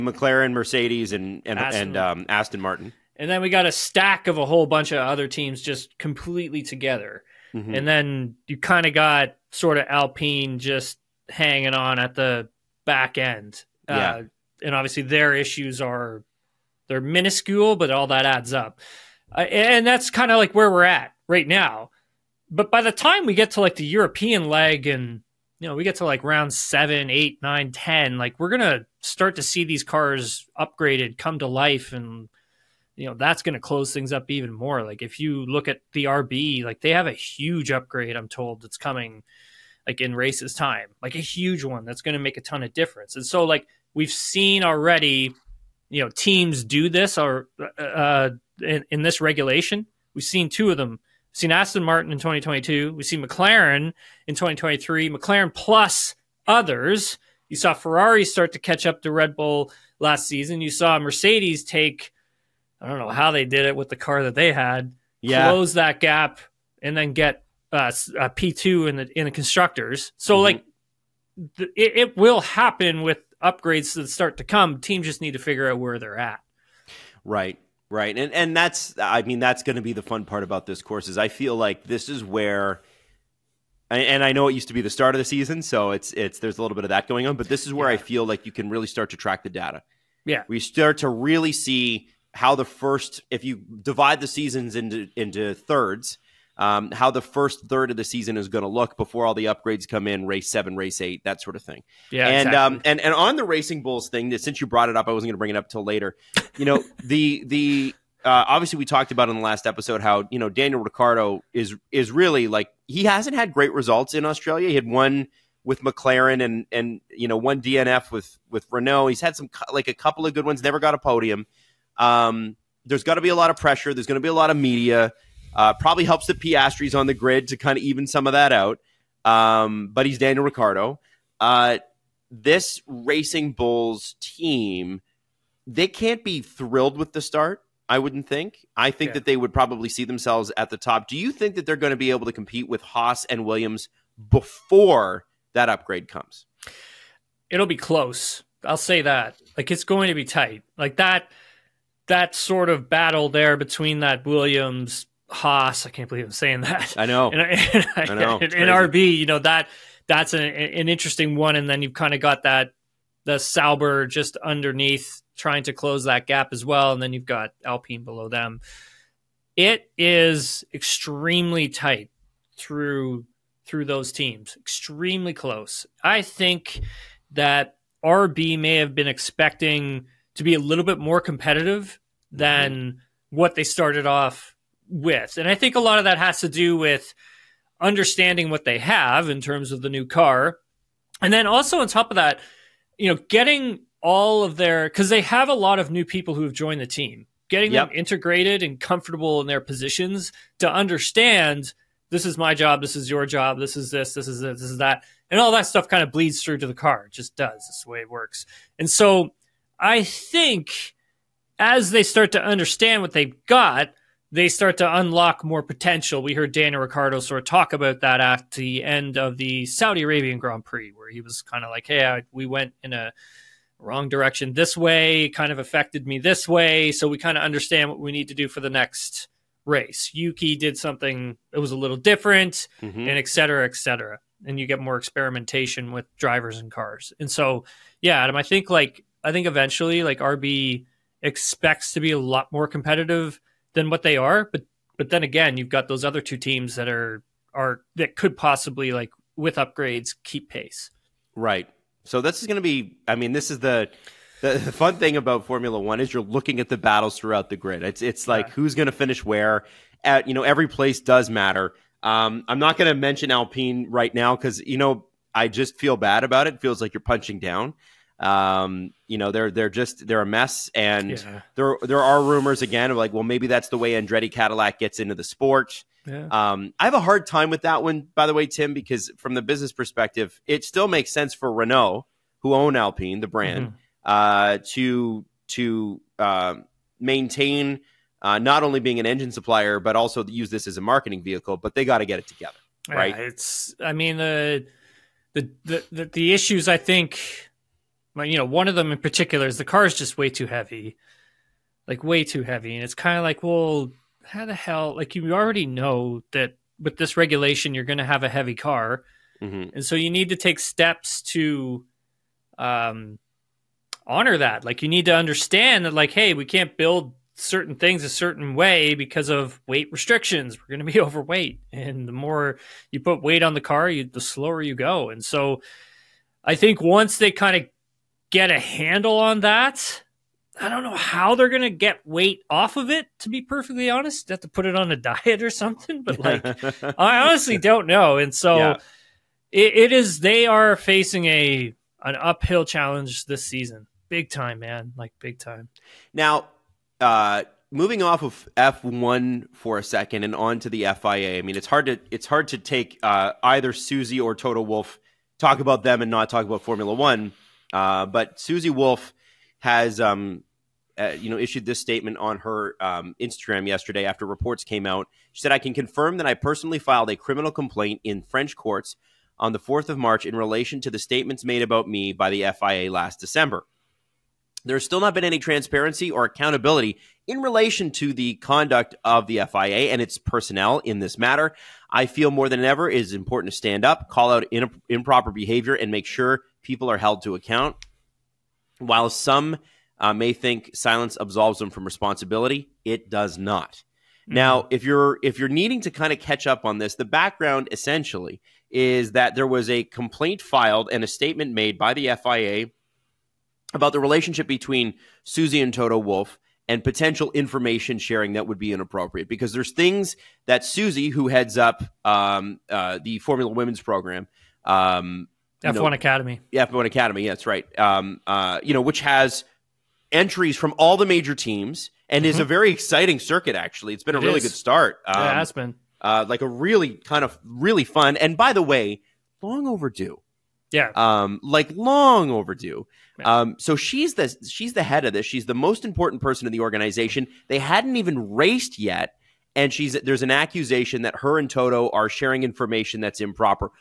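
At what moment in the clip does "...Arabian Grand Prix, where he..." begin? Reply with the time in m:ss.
3:40.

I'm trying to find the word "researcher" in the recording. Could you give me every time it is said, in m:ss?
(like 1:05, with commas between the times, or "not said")
not said.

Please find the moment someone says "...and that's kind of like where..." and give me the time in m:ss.
0:19.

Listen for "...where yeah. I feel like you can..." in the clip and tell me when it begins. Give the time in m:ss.
1:27.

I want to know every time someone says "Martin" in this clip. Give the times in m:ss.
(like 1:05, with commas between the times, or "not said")
0:02, 0:51.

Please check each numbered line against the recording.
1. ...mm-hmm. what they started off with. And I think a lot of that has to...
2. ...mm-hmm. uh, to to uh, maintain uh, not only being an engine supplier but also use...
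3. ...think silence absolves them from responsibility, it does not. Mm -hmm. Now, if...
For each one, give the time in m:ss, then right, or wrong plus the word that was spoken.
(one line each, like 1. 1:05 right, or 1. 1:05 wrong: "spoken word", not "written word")
1. 3:02 right
2. 4:43 right
3. 6:30 right.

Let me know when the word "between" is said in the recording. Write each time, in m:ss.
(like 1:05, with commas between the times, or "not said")
2:33, 6:44.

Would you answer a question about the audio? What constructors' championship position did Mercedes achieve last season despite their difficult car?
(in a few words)
P2.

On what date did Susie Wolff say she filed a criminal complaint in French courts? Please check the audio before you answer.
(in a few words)
4 March.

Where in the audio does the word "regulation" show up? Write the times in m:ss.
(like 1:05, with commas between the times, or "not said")
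0:49, 5:07.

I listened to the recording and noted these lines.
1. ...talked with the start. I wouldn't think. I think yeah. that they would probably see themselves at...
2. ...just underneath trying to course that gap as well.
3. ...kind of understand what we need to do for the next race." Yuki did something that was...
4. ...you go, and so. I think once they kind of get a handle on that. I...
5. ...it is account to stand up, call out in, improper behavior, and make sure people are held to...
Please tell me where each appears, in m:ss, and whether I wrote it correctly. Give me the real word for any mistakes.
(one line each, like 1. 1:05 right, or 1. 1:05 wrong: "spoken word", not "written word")
1. 2:16 wrong: "thrilled", not "talked"
2. 2:44 wrong: "close", not "course"
3. 3:47 right
4. 5:24 right
5. 6:22 wrong: "important", not "account".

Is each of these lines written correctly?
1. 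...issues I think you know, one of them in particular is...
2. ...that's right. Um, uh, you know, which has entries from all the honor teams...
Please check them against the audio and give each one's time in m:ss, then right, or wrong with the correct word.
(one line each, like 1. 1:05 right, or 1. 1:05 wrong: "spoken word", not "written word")
1. 4:56 right
2. 6:57 wrong: "major", not "honor".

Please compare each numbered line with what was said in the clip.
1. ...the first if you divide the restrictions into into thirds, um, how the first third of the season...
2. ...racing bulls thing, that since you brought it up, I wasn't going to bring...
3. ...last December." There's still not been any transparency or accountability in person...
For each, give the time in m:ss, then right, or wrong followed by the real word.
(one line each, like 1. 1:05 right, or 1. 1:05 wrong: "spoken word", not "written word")
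1. 1:32 wrong: "seasons", not "restrictions"
2. 1:43 right
3. 6:12 wrong: "relation", not "person".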